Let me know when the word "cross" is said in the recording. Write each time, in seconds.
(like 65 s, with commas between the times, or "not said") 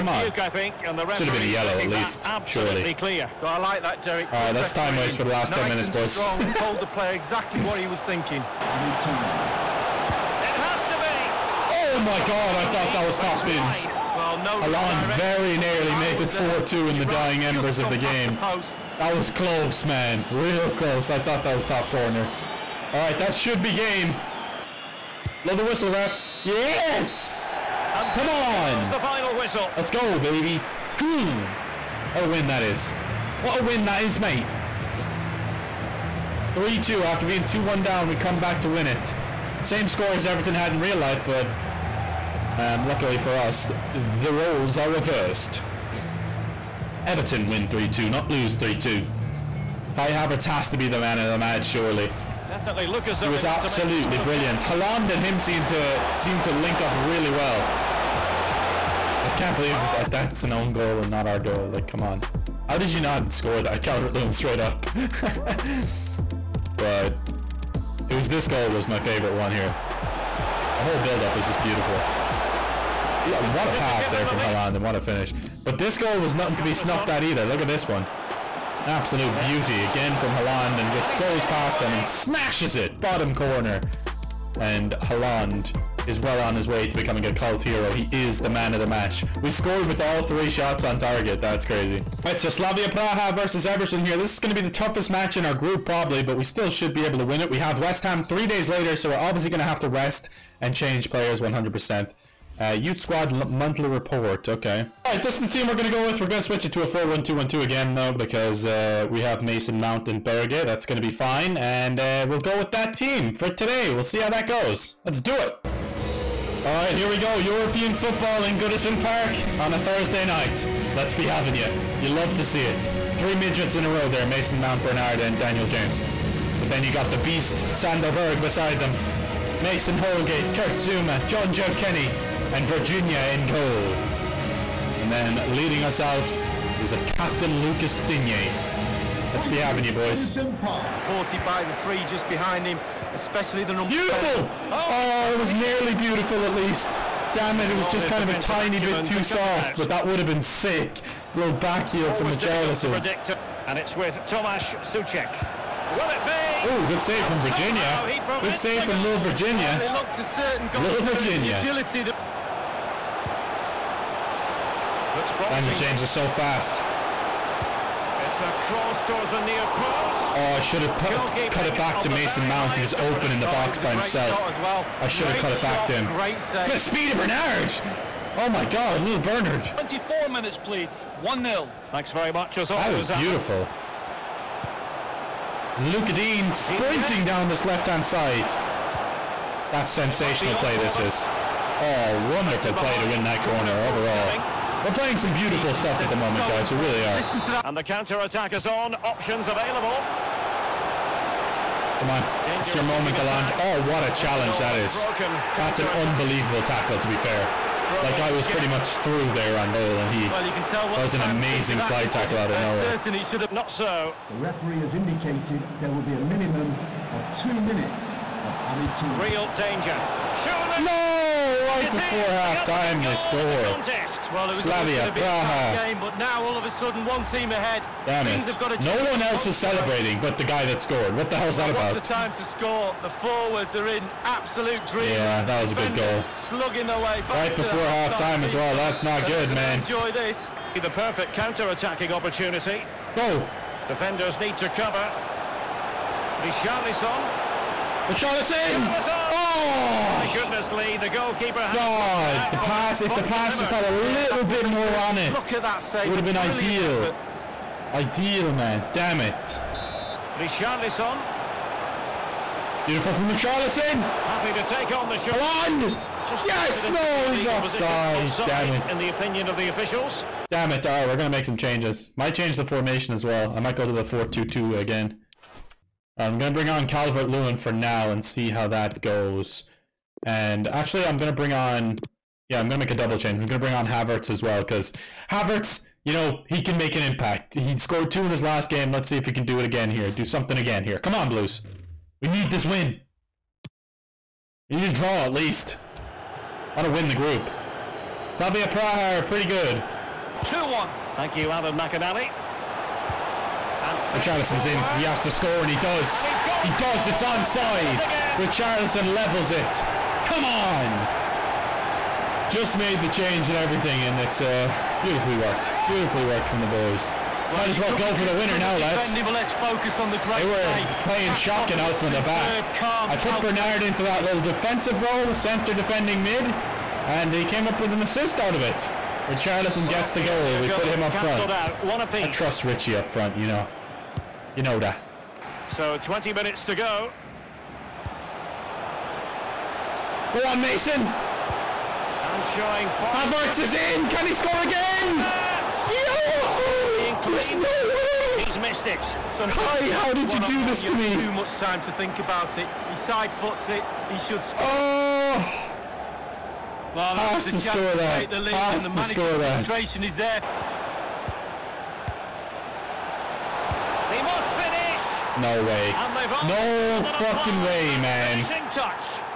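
168 s.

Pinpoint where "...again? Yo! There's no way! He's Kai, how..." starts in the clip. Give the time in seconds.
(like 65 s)
344 s.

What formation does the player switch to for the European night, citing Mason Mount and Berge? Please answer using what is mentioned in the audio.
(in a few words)
4-1-2-1-2.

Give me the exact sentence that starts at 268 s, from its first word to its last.
In the opinion of the officials.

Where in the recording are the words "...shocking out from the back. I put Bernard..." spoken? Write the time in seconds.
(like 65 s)
321 s.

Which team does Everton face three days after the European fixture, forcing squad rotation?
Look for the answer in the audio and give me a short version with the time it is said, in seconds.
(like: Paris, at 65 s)
West Ham, at 97 s.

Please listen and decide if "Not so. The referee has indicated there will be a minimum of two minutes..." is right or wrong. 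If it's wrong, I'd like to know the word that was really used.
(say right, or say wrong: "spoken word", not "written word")
right.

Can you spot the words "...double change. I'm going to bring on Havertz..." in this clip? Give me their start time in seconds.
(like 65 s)
282 s.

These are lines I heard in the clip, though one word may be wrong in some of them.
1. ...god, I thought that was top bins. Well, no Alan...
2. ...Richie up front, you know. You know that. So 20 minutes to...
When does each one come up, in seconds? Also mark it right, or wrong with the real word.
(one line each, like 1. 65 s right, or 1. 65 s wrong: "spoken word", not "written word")
1. 12 s right
2. 332 s right.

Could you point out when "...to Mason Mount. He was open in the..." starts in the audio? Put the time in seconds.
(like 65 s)
172 s.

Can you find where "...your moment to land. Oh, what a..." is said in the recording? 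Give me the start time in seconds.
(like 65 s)
202 s.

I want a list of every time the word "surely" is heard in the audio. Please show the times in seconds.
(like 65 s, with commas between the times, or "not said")
2 s, 51 s.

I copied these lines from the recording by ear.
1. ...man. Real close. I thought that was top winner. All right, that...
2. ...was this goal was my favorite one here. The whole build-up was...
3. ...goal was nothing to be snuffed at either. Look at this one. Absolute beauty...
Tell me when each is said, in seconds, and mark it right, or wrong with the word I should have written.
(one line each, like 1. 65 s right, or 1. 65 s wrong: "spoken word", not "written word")
1. 19 s wrong: "corner", not "winner"
2. 68 s right
3. 75 s right.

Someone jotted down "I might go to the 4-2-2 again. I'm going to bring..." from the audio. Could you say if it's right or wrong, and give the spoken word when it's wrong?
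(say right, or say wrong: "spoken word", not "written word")
right.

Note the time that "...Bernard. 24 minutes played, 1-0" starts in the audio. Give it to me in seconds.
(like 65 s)
179 s.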